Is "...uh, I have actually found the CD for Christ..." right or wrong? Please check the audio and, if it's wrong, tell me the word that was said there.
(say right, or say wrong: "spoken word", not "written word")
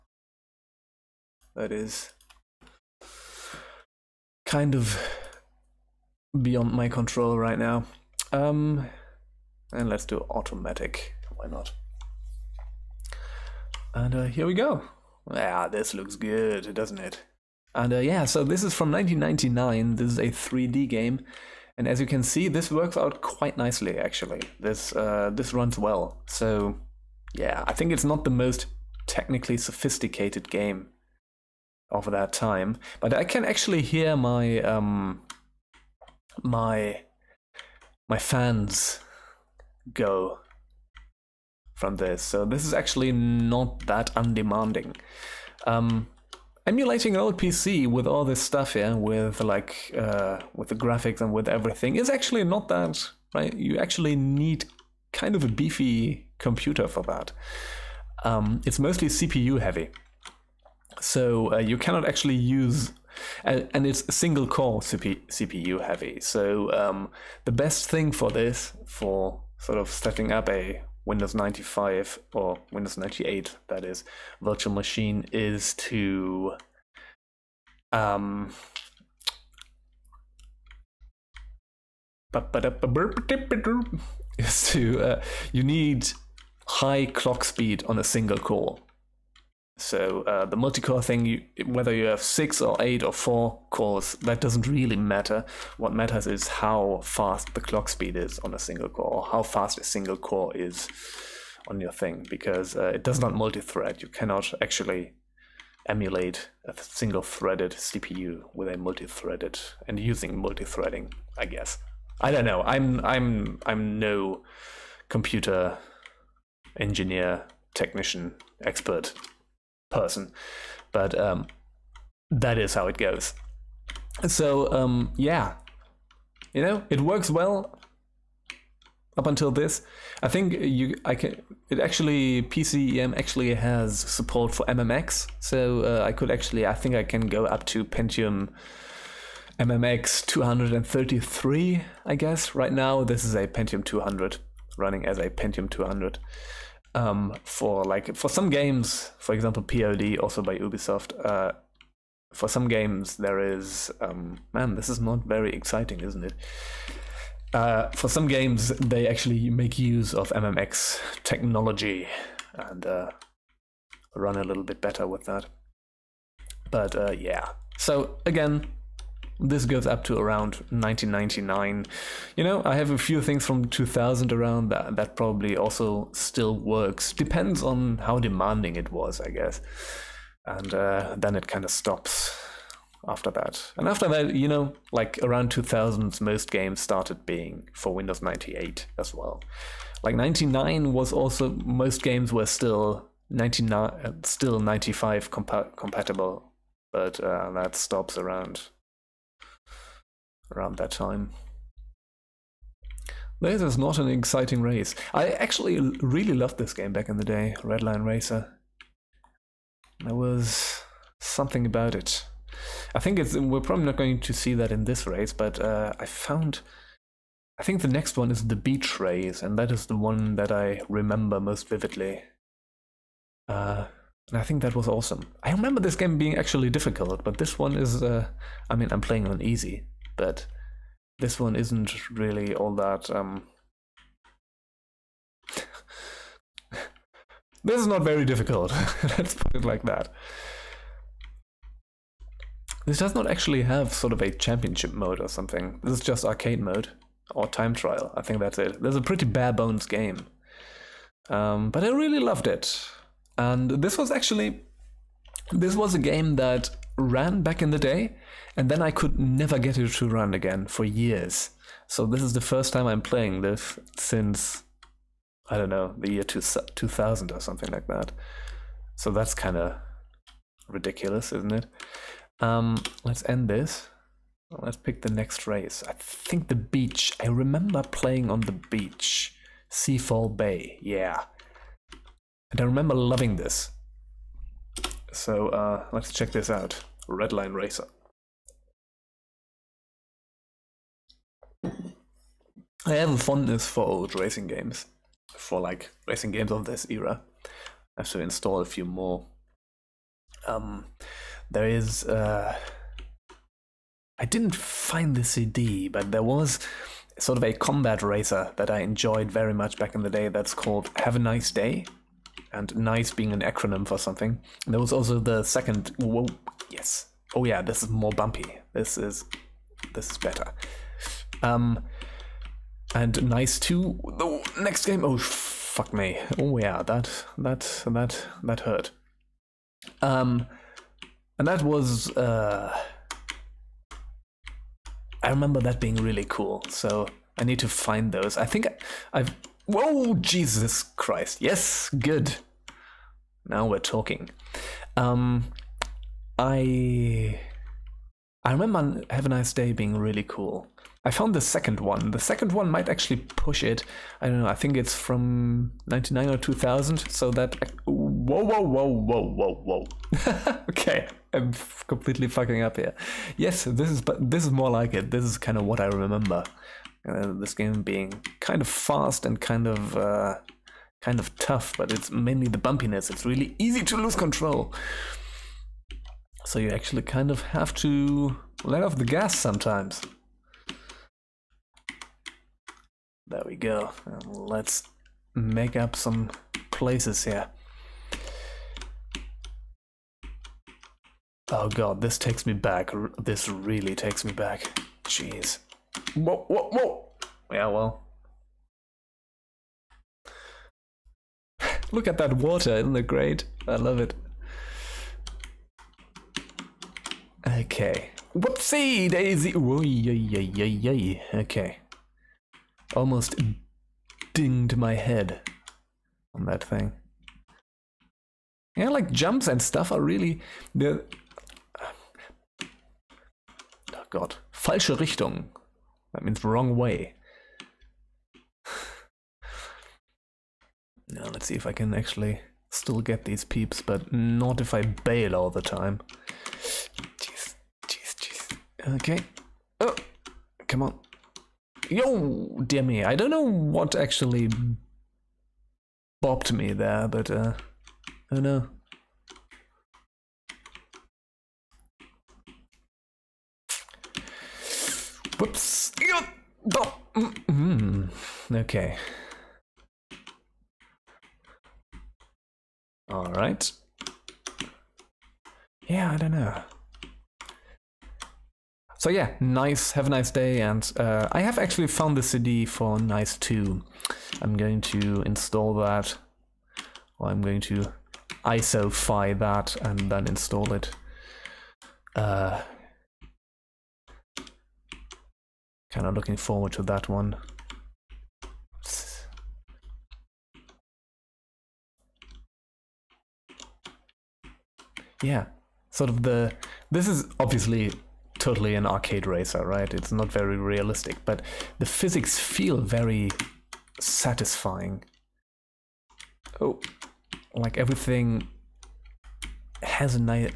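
wrong: "Nice", not "Christ".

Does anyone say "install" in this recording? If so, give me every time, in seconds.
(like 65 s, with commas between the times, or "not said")
298 s, 475 s, 480 s.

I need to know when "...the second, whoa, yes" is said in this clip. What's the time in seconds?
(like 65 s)
315 s.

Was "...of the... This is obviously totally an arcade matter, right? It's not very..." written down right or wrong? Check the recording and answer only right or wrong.
wrong.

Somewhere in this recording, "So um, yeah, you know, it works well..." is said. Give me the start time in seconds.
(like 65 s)
124 s.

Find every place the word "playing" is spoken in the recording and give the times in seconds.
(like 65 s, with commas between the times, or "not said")
229 s, 263 s, 277 s.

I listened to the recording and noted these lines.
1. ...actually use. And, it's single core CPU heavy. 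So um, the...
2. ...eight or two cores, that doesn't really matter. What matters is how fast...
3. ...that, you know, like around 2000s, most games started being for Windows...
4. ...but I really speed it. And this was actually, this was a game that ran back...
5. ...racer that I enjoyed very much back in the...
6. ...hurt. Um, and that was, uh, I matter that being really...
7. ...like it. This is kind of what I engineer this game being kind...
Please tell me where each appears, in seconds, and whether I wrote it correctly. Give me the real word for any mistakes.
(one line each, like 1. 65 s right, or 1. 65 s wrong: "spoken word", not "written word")
1. 62 s right
2. 92 s wrong: "four", not "two"
3. 184 s right
4. 251 s wrong: "loved", not "speed"
5. 308 s right
6. 328 s wrong: "remember", not "matter"
7. 364 s wrong: "remember", not "engineer".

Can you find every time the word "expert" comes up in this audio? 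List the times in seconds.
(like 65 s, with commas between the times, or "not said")
118 s.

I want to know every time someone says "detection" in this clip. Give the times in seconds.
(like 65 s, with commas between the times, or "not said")
not said.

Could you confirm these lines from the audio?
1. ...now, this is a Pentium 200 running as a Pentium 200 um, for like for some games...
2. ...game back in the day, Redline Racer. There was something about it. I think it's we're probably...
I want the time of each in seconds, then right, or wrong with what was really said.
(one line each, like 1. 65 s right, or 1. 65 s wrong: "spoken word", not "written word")
1. 142 s right
2. 206 s right.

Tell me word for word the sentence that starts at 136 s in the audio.
I think I can go up to Pentium.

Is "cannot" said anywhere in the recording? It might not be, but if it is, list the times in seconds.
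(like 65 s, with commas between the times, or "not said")
61 s, 104 s.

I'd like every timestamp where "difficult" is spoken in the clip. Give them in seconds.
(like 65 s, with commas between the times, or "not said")
226 s, 238 s.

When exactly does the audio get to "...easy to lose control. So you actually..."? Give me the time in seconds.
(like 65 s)
373 s.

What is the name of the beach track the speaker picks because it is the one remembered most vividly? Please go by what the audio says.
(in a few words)
Seafall Bay.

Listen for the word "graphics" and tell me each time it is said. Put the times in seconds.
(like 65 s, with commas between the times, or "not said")
50 s.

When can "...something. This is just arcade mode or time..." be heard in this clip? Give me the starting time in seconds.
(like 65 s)
245 s.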